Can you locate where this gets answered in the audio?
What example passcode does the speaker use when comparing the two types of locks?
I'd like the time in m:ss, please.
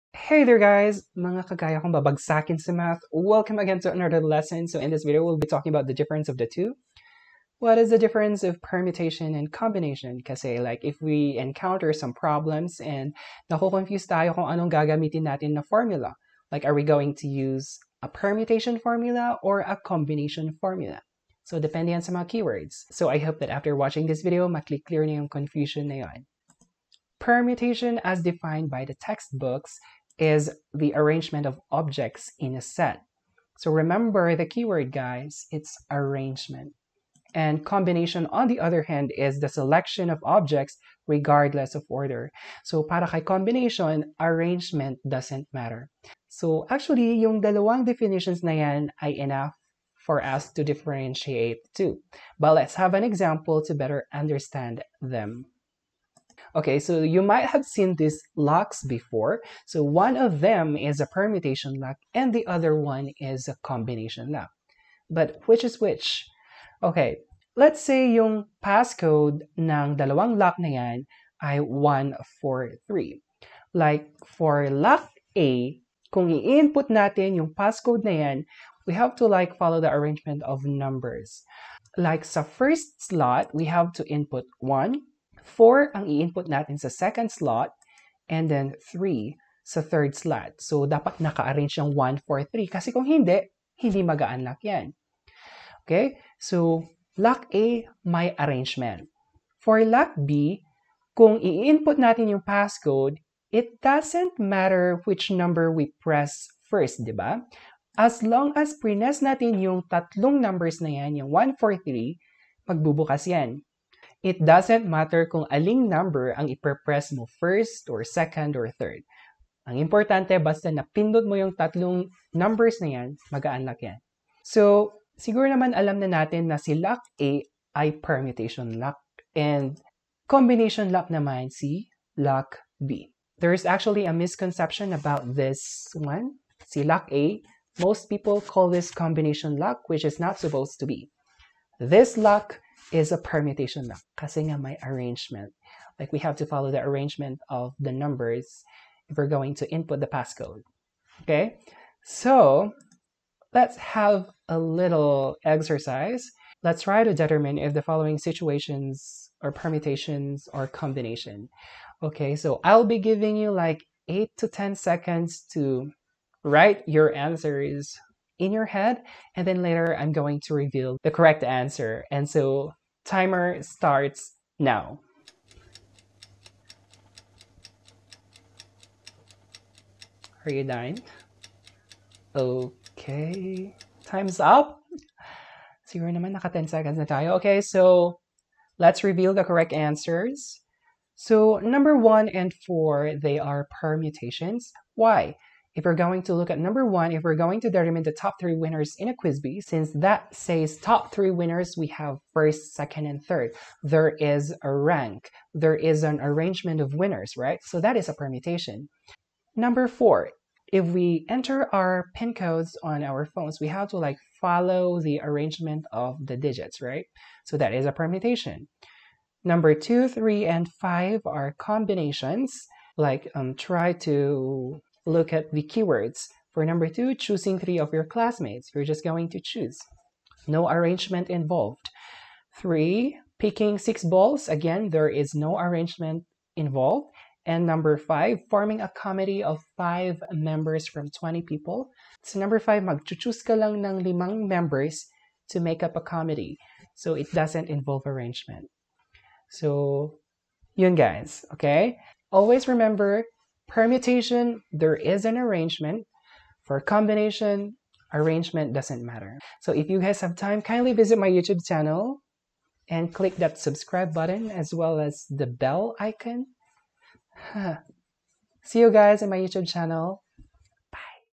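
1:11.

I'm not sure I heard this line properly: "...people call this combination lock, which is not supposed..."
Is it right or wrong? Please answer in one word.
right.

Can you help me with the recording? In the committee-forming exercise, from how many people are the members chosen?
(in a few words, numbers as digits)
20.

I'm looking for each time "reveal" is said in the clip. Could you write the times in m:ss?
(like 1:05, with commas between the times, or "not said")
2:50, 3:09.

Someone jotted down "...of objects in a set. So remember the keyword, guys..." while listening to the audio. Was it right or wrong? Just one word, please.
right.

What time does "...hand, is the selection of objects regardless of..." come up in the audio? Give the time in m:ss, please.
0:38.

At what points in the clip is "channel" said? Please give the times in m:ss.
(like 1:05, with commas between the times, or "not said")
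4:21, 4:29.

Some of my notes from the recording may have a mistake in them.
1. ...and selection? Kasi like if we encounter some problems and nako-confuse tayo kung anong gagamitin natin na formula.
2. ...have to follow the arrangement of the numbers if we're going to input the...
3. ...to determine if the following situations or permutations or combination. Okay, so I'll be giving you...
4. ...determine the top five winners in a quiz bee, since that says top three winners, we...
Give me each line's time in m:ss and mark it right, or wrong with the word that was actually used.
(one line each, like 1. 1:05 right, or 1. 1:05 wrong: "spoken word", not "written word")
1. 0:09 wrong: "combination", not "selection"
2. 2:26 right
3. 2:37 right
4. 3:17 wrong: "three", not "five".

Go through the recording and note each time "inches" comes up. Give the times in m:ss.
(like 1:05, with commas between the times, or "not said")
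not said.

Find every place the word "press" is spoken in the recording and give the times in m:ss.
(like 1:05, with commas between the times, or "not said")
1:46, 1:56.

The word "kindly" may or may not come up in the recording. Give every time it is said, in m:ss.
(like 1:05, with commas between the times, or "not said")
4:20.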